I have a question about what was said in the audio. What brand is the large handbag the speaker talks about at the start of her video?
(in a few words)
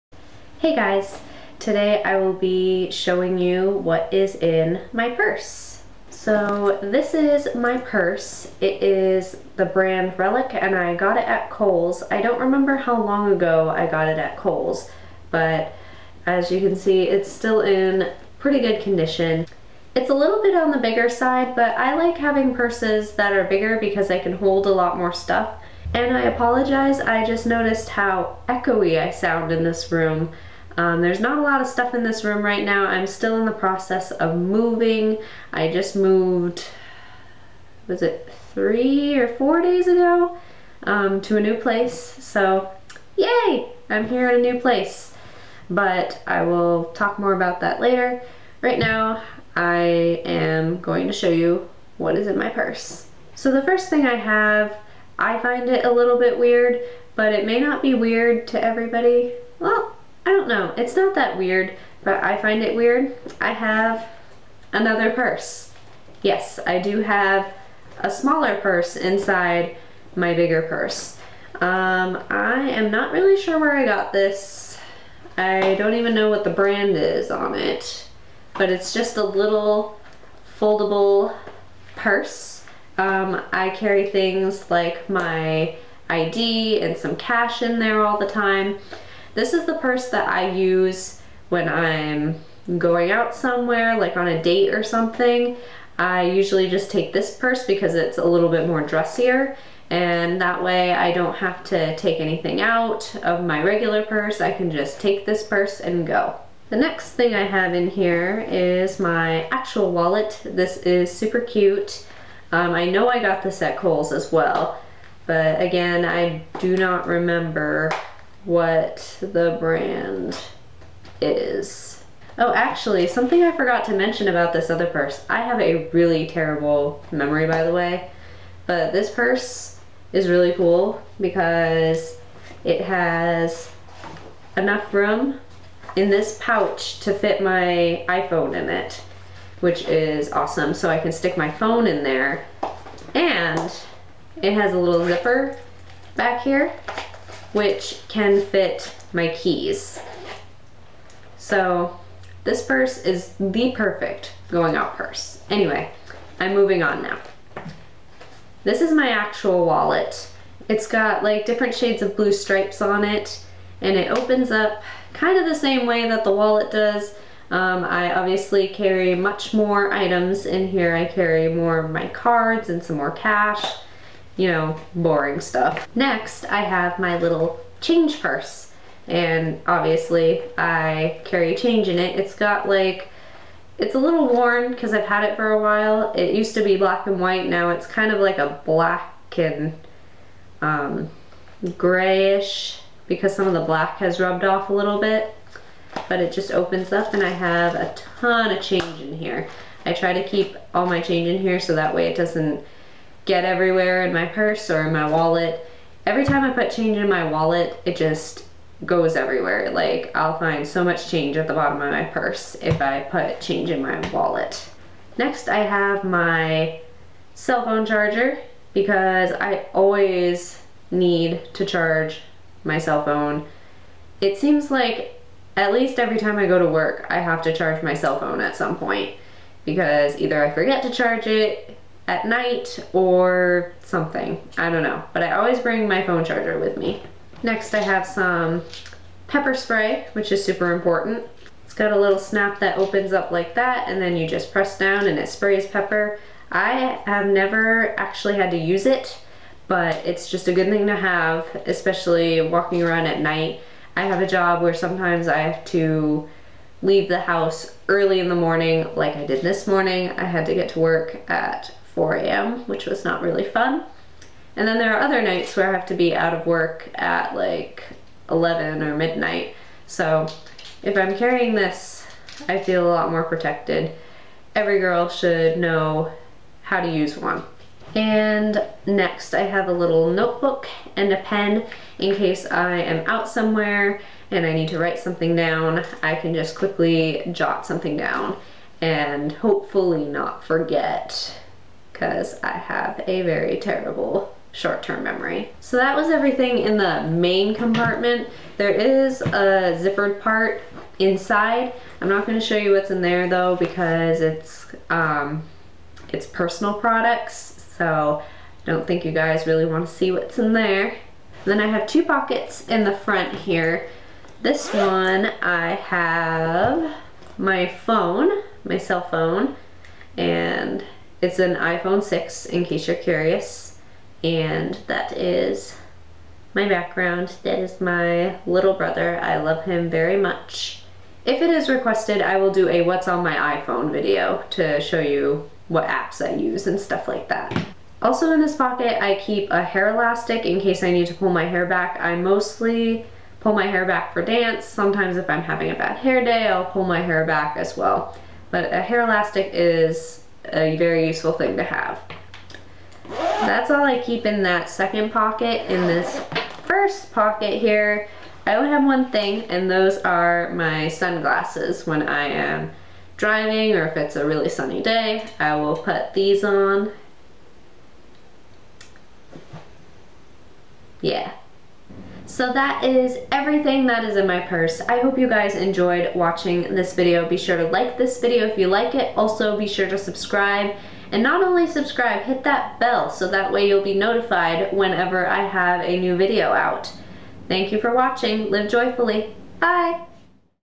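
Relic.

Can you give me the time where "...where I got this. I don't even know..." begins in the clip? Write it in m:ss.
1:13.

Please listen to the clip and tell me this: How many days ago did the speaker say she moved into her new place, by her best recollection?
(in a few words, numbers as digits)
3 or 4.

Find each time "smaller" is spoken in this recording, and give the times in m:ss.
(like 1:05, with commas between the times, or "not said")
1:08.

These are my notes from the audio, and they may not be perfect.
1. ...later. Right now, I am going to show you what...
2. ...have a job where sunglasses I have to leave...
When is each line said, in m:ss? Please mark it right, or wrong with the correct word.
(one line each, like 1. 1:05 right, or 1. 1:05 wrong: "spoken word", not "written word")
1. 0:47 right
2. 4:14 wrong: "sometimes", not "sunglasses".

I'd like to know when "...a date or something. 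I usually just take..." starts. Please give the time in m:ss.
1:34.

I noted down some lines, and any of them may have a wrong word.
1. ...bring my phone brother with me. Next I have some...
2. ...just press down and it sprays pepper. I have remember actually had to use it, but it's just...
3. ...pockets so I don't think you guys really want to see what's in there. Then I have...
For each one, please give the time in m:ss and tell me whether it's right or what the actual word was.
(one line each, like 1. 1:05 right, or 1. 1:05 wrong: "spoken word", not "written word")
1. 3:55 wrong: "charger", not "brother"
2. 4:04 wrong: "never", not "remember"
3. 5:06 wrong: "products", not "pockets".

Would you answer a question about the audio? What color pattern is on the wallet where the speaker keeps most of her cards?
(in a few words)
Different shades of blue stripes.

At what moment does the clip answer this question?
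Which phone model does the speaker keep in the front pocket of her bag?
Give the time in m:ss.
5:21.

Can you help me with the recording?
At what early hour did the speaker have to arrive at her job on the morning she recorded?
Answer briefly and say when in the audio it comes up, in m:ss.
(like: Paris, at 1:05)
4 a.m., at 4:22.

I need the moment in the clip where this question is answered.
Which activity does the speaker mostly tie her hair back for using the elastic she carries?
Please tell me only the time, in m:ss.
5:44.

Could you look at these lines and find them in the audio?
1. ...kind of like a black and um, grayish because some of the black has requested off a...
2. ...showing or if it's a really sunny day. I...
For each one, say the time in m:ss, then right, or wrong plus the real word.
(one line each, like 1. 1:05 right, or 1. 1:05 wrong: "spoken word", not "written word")
1. 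3:07 wrong: "rubbed", not "requested"
2. 6:03 wrong: "driving", not "showing".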